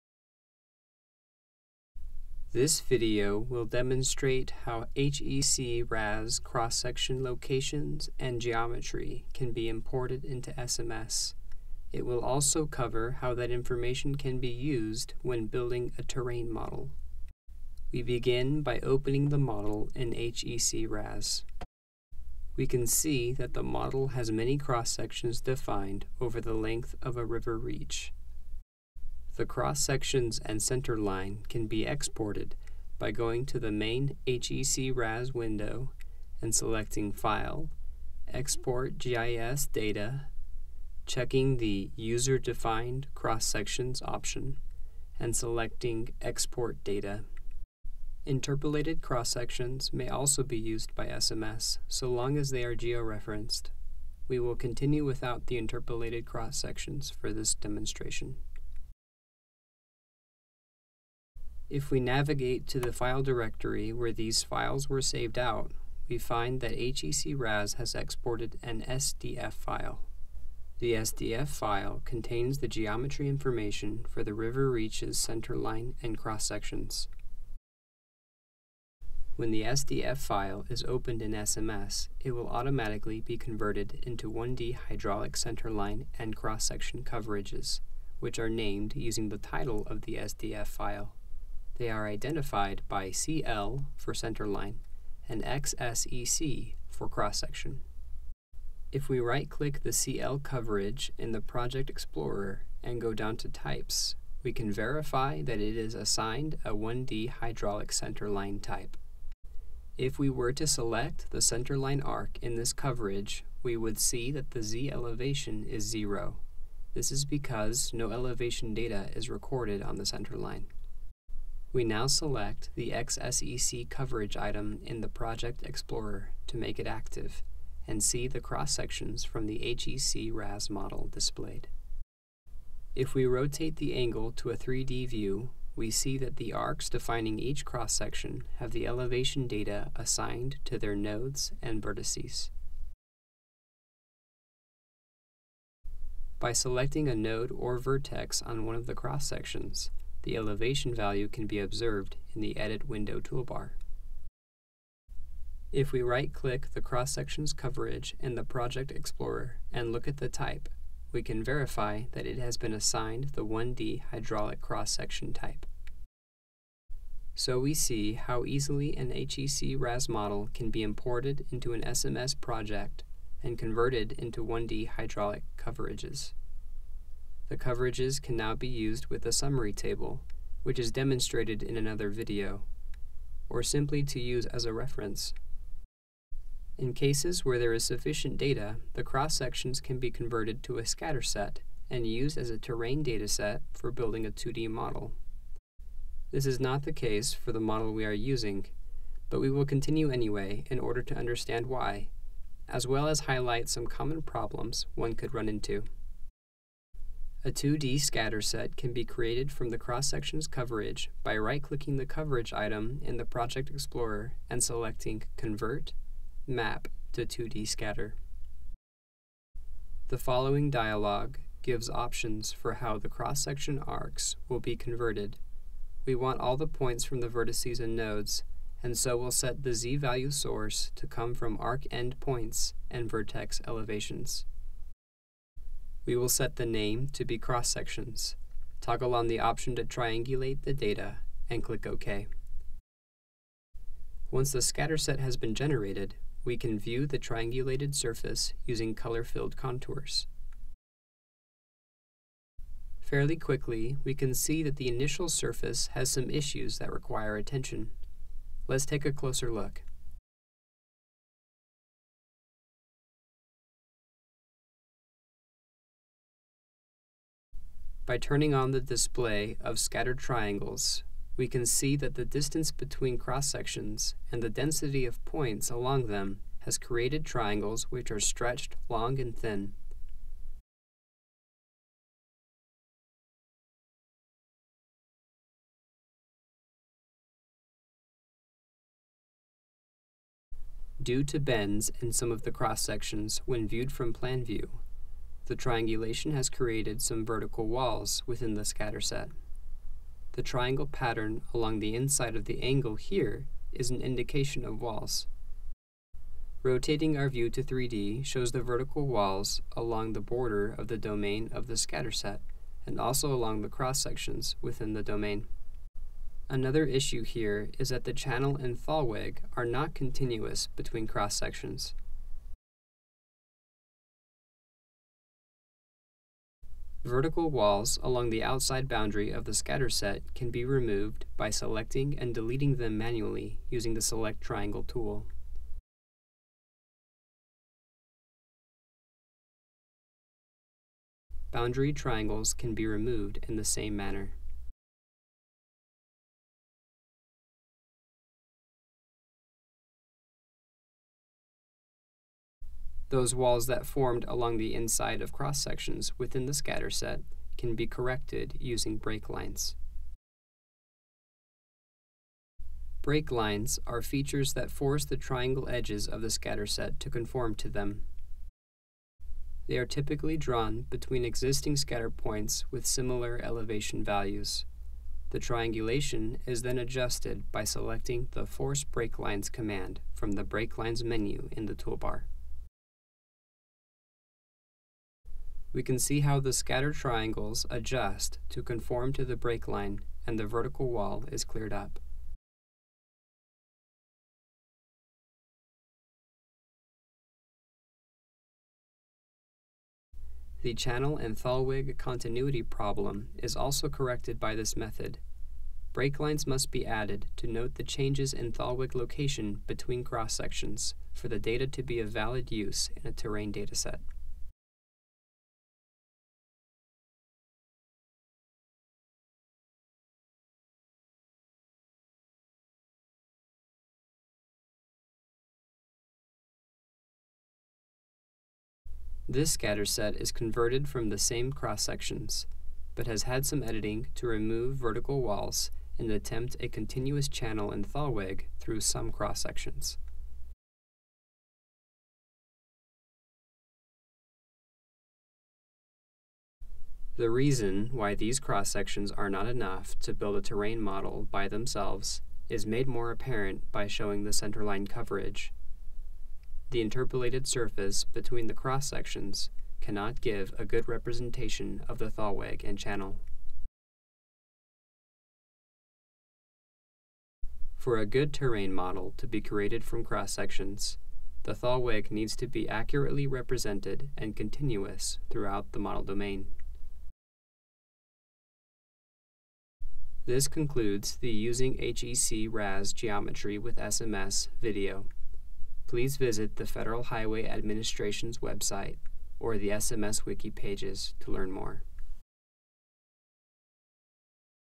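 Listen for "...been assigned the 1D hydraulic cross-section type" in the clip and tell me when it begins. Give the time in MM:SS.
02:42.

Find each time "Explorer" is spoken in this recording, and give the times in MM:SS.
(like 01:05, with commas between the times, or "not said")
01:41, 02:05, 02:38, 03:33.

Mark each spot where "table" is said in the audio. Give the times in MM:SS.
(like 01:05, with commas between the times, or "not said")
02:59.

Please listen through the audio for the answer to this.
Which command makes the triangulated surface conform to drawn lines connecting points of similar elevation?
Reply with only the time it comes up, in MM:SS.
06:18.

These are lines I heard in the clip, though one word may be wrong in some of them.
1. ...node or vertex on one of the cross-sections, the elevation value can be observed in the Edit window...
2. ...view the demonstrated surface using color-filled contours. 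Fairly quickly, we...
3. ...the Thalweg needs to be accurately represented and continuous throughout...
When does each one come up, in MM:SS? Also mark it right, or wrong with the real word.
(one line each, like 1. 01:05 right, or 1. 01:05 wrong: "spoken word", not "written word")
1. 02:27 right
2. 04:06 wrong: "triangulated", not "demonstrated"
3. 07:51 right.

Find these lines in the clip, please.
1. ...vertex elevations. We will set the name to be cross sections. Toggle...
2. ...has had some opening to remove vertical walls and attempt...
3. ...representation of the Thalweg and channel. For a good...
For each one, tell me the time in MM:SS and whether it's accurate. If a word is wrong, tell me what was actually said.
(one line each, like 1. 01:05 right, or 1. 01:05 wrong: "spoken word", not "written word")
1. 03:53 right
2. 07:13 wrong: "editing", not "opening"
3. 07:40 right.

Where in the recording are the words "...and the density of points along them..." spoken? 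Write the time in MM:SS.
04:34.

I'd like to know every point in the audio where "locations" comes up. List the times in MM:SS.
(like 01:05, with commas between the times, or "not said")
00:07, 06:48.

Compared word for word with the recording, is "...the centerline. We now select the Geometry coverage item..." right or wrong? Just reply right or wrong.
wrong.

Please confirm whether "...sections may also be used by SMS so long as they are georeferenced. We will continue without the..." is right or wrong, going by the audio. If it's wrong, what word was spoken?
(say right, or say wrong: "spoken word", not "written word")
right.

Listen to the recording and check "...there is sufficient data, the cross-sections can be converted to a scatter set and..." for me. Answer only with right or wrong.
right.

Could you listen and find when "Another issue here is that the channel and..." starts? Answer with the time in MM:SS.
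05:16.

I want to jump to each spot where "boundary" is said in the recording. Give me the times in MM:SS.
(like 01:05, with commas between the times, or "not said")
05:28, 05:41.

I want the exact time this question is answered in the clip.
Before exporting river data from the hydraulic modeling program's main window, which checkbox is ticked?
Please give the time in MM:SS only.
00:41.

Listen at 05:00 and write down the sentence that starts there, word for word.
The triangle pattern along the inside of the angle here is an indication of walls.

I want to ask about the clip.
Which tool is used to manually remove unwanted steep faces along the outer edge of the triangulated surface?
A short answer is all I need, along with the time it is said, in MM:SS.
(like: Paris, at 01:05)
Select Triangle tool, at 05:34.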